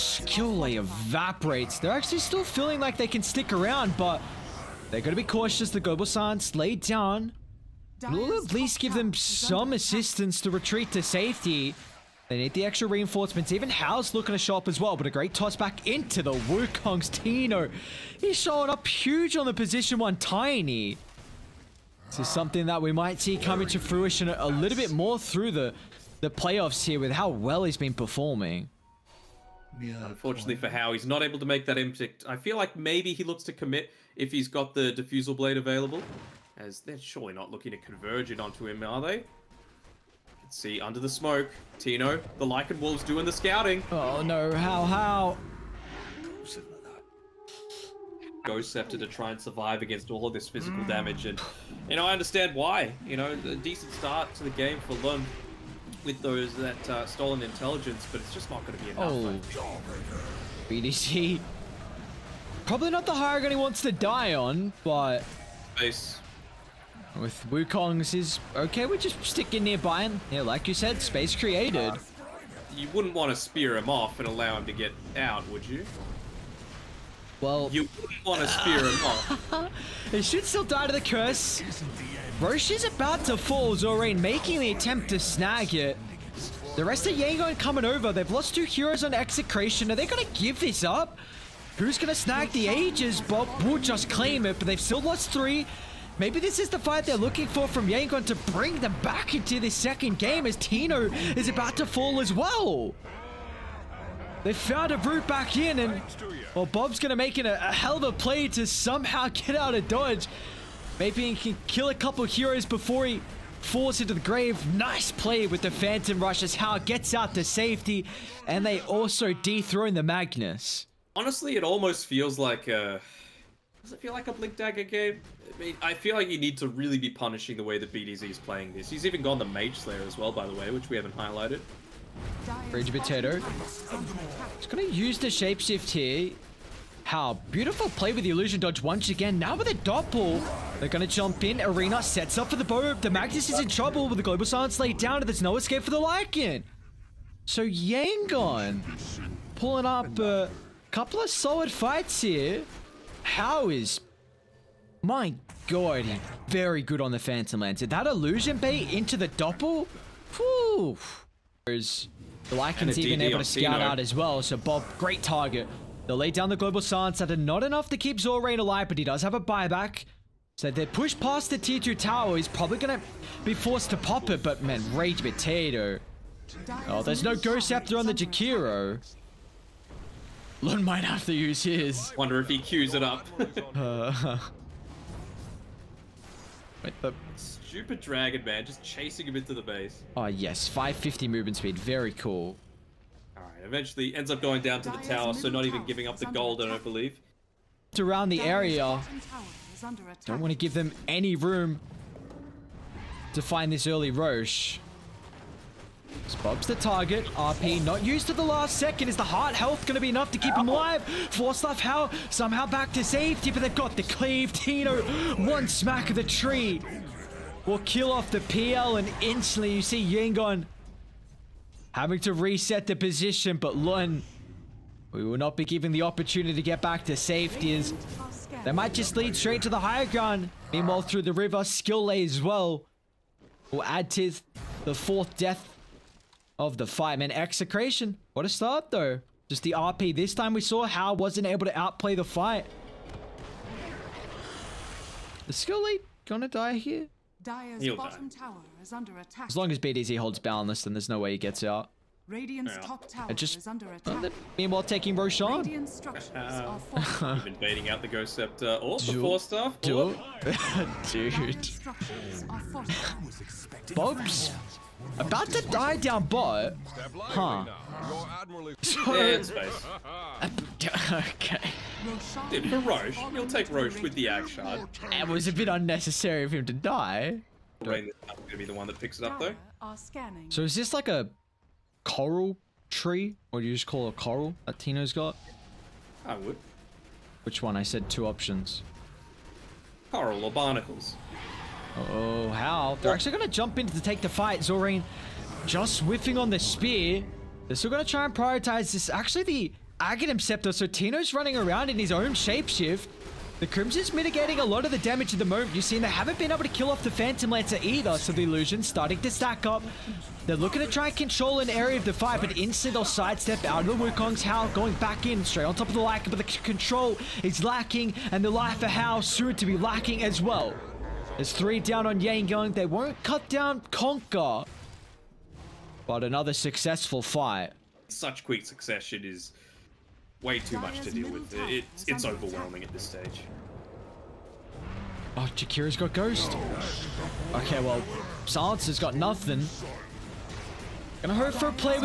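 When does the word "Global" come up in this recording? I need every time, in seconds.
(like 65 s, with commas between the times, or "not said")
144 s, 166 s.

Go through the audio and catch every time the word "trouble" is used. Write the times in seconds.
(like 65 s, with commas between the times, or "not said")
143 s.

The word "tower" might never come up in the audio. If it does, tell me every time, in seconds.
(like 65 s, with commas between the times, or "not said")
171 s, 194 s, 248 s, 253 s.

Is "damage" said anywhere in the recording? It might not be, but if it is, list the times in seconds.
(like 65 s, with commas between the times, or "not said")
50 s, 304 s.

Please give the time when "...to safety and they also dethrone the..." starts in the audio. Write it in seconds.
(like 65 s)
117 s.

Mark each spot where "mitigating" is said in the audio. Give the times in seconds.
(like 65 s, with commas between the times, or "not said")
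304 s.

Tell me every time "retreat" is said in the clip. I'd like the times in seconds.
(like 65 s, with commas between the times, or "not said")
10 s.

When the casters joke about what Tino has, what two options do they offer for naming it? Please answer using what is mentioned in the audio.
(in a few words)
Coral or barnacles.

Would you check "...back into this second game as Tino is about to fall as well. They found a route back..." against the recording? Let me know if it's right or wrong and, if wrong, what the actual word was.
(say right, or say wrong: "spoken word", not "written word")
right.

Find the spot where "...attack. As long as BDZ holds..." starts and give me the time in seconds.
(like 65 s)
249 s.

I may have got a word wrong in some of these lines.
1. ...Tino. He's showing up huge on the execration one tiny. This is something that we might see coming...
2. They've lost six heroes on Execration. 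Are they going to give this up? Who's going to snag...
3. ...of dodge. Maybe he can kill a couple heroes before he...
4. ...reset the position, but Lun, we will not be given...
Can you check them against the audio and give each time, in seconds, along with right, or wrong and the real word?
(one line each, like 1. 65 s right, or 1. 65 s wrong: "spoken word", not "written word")
1. 17 s wrong: "position", not "execration"
2. 88 s wrong: "two", not "six"
3. 109 s right
4. 222 s right.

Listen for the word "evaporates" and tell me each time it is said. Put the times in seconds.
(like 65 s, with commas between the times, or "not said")
0 s.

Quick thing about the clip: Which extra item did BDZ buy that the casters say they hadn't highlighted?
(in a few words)
Mage Slayer.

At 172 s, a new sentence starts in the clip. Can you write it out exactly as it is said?
He's probably going to be forced to pop it, but man, Rage Potato.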